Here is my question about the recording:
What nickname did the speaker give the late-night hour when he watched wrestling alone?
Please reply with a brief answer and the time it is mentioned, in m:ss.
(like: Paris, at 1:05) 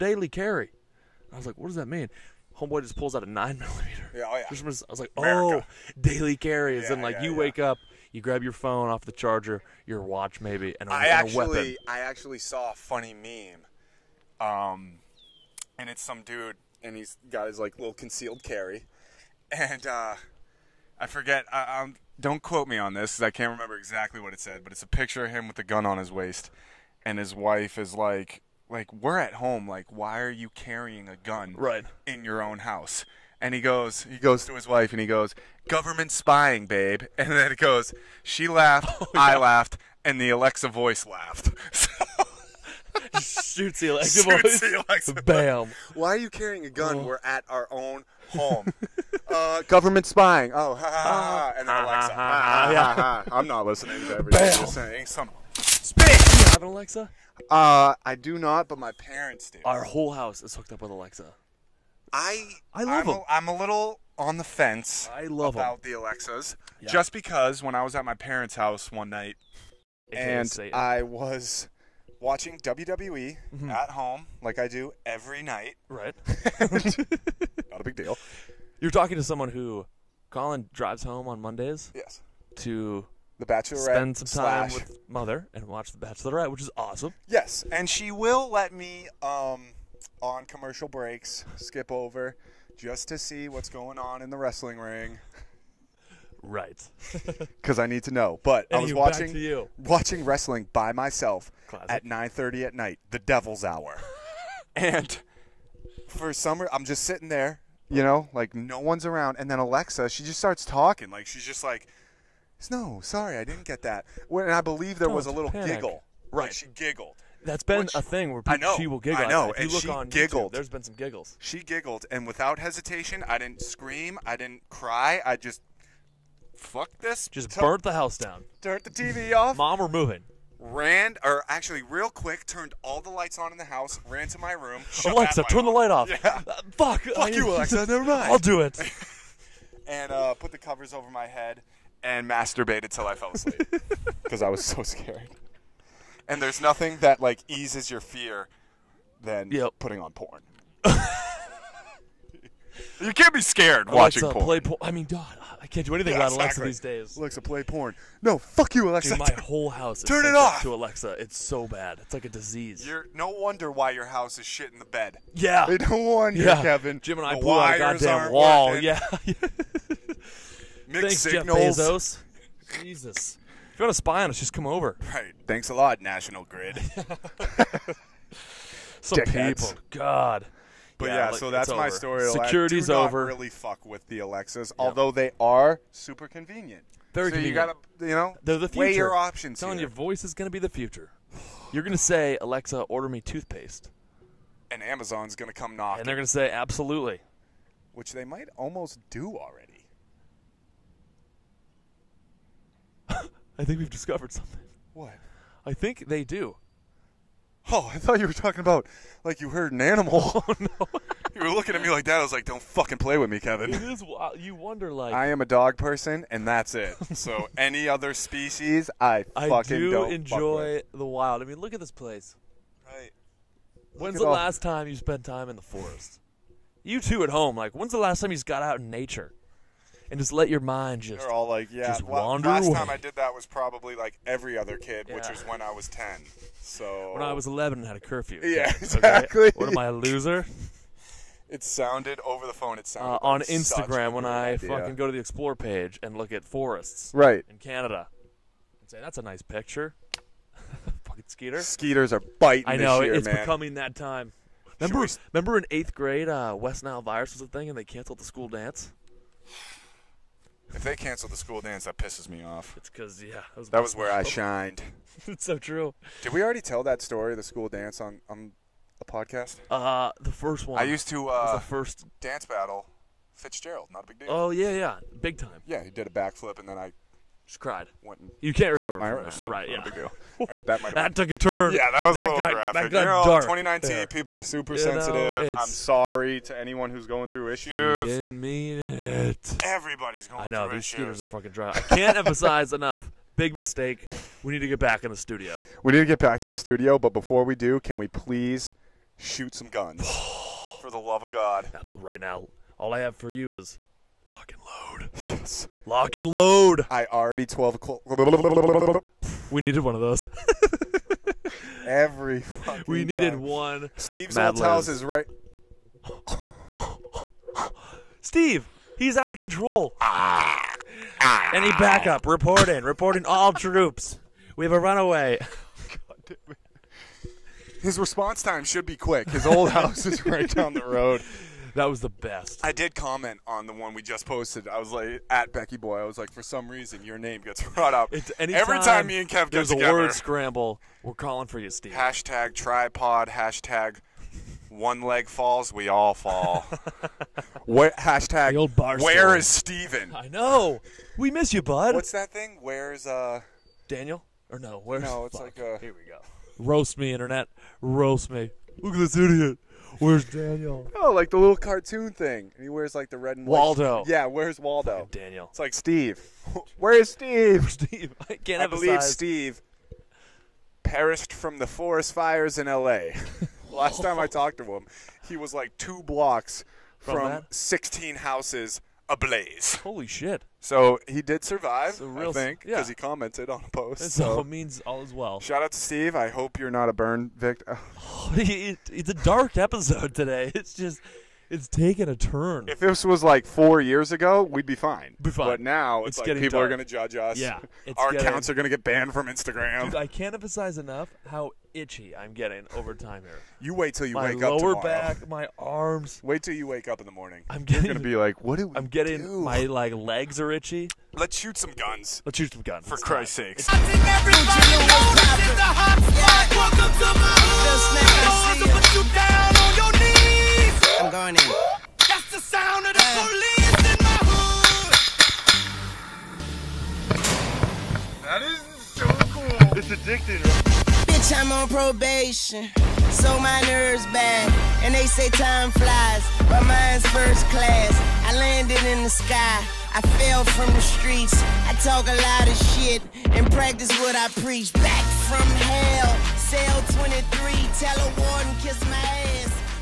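the Devil's Hour, at 1:43.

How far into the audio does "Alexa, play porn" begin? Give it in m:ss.
2:37.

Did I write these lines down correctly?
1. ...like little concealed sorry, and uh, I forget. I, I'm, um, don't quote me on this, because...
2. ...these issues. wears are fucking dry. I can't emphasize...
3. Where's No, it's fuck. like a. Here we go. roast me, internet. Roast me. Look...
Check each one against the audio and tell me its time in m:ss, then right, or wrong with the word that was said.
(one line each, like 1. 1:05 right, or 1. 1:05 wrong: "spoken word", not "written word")
1. 0:17 wrong: "carry", not "sorry"
2. 4:50 wrong: "scooters", not "wears"
3. 5:54 right.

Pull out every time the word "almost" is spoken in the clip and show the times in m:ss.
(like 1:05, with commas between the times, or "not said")
3:18.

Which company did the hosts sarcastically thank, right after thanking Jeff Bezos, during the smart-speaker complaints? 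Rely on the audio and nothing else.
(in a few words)
National Grid.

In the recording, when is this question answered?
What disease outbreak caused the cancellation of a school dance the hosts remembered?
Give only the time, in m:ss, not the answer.
4:16.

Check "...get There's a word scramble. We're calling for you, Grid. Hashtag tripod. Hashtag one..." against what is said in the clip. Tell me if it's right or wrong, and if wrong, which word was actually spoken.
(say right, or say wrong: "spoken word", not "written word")
wrong: "Steve", not "Grid".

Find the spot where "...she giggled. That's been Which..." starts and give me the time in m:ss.
1:56.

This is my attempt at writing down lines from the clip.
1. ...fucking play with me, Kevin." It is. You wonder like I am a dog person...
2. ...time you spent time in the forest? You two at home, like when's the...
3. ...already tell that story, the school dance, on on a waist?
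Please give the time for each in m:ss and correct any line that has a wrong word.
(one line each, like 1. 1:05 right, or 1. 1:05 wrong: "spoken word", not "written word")
1. 3:32 right
2. 3:44 right
3. 4:26 wrong: "podcast", not "waist".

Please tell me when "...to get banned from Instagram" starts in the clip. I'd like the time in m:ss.
6:38.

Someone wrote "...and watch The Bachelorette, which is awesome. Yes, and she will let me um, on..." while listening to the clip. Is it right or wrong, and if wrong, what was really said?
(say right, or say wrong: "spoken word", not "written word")
right.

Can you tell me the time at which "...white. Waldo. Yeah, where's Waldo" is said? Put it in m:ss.
6:03.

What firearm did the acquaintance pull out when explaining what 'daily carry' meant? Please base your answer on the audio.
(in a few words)
nine millimeter.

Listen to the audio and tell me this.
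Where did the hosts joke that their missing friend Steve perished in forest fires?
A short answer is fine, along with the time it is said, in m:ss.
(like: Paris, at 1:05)
L.A., at 6:12.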